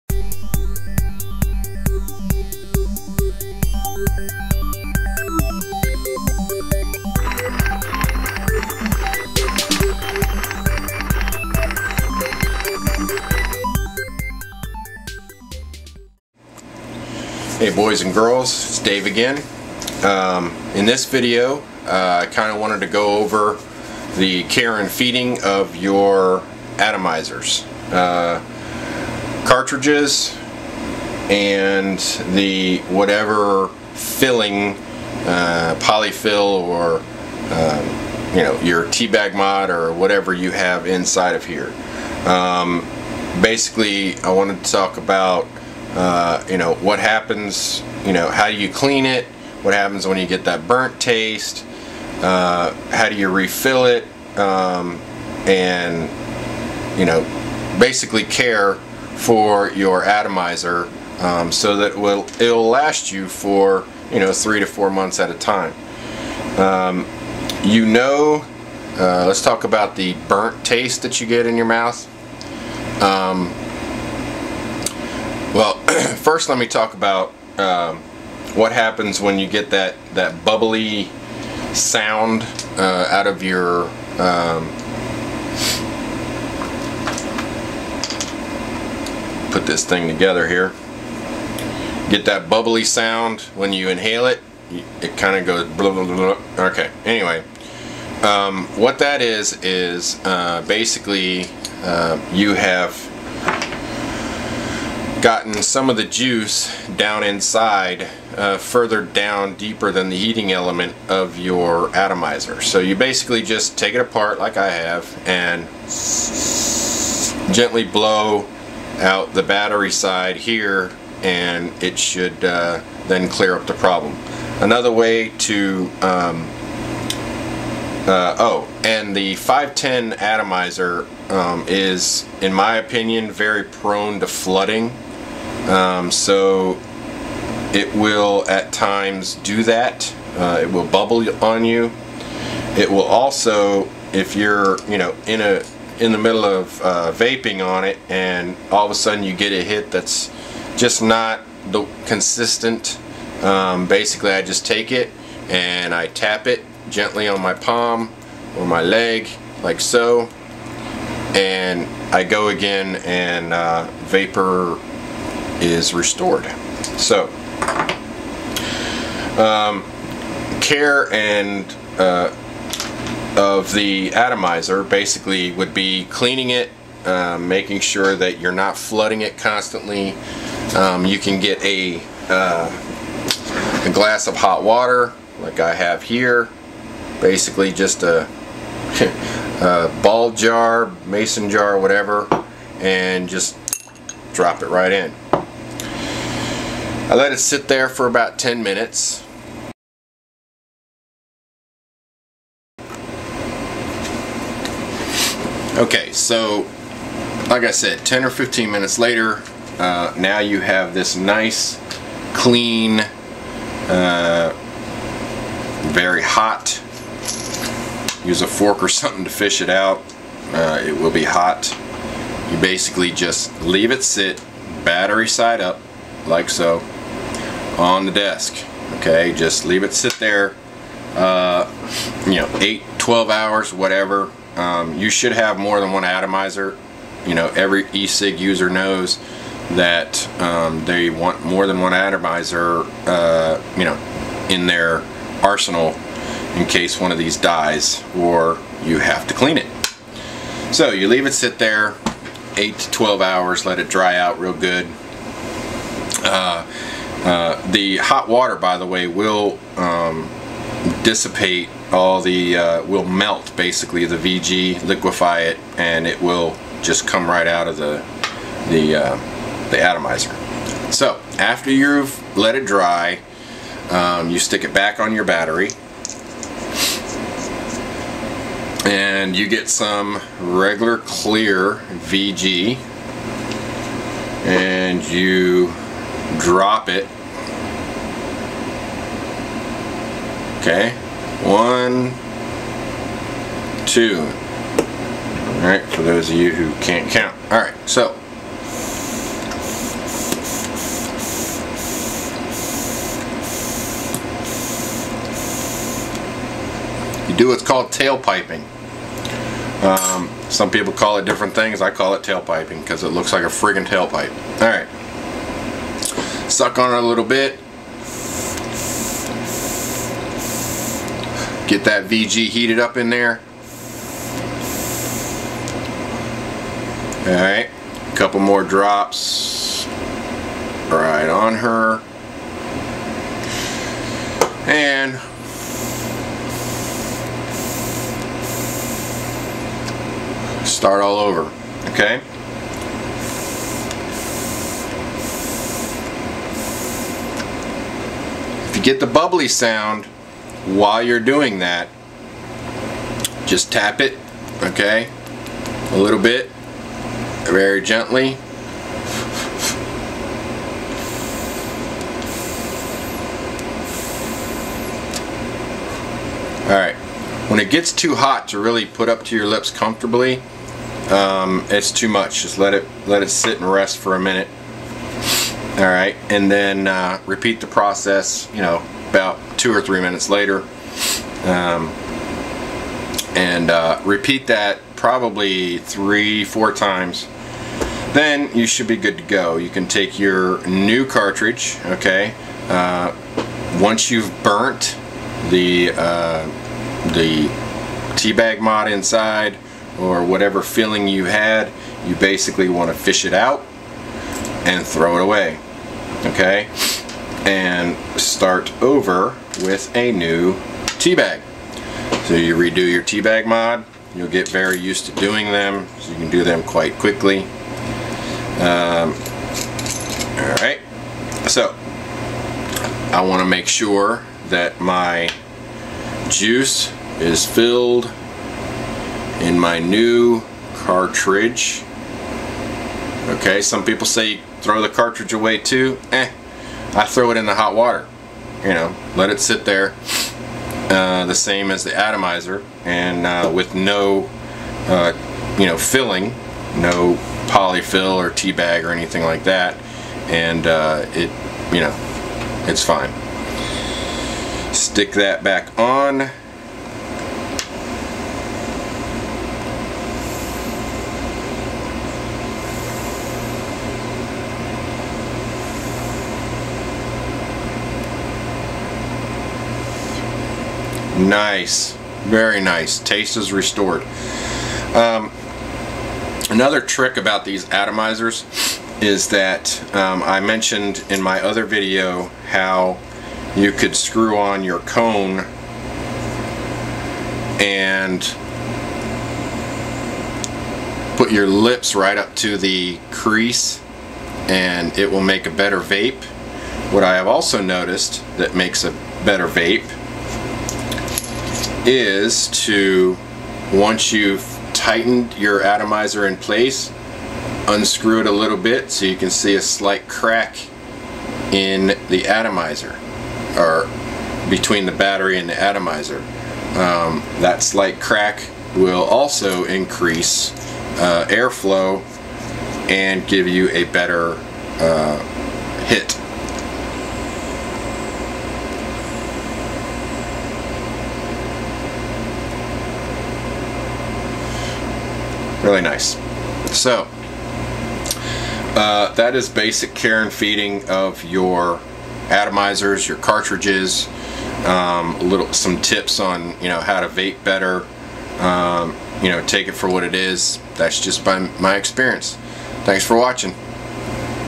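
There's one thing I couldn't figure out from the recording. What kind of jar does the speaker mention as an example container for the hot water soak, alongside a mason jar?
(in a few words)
Ball jar.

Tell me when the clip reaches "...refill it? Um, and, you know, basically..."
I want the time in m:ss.
0:53.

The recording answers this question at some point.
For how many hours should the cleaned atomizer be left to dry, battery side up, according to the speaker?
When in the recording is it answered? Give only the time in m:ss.
4:12.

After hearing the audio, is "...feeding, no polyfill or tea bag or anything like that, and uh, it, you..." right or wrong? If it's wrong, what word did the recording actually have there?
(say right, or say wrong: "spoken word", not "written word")
wrong: "filling", not "feeding".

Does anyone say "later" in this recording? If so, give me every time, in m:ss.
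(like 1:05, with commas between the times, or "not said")
3:28, 6:20.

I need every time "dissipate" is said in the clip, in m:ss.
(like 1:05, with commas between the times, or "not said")
4:21.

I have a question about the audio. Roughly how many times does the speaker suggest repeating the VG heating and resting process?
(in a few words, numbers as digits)
3 or 4 times.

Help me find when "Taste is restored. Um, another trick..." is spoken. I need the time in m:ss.
7:52.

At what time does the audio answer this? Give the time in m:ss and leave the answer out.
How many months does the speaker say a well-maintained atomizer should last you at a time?
1:04.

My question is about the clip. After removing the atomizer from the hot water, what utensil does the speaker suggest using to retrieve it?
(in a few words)
Fork.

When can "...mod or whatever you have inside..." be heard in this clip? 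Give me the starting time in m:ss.
0:39.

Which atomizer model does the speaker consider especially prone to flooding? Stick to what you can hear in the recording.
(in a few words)
510.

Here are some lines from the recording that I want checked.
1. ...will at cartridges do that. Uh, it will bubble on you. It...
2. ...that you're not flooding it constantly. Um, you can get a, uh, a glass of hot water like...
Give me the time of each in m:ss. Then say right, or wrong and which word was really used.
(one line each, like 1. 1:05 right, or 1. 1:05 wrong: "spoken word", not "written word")
1. 2:17 wrong: "times", not "cartridges"
2. 2:58 right.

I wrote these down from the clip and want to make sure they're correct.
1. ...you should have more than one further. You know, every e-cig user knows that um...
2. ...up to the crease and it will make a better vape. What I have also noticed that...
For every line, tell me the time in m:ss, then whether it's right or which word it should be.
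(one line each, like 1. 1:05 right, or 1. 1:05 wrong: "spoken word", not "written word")
1. 3:54 wrong: "atomizer", not "further"
2. 8:12 right.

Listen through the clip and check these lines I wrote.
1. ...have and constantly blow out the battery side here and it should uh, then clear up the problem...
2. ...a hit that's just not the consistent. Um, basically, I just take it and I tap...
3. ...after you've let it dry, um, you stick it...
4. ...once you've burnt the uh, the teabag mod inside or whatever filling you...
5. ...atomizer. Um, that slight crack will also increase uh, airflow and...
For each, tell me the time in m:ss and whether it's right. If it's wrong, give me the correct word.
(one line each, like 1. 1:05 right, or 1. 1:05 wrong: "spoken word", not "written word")
1. 1:54 wrong: "gently", not "constantly"
2. 2:29 right
3. 4:31 right
4. 6:33 right
5. 8:35 right.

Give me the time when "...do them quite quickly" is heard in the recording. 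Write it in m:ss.
6:56.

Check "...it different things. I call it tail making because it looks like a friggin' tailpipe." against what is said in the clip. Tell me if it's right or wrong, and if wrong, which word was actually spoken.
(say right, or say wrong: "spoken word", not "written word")
wrong: "piping", not "making".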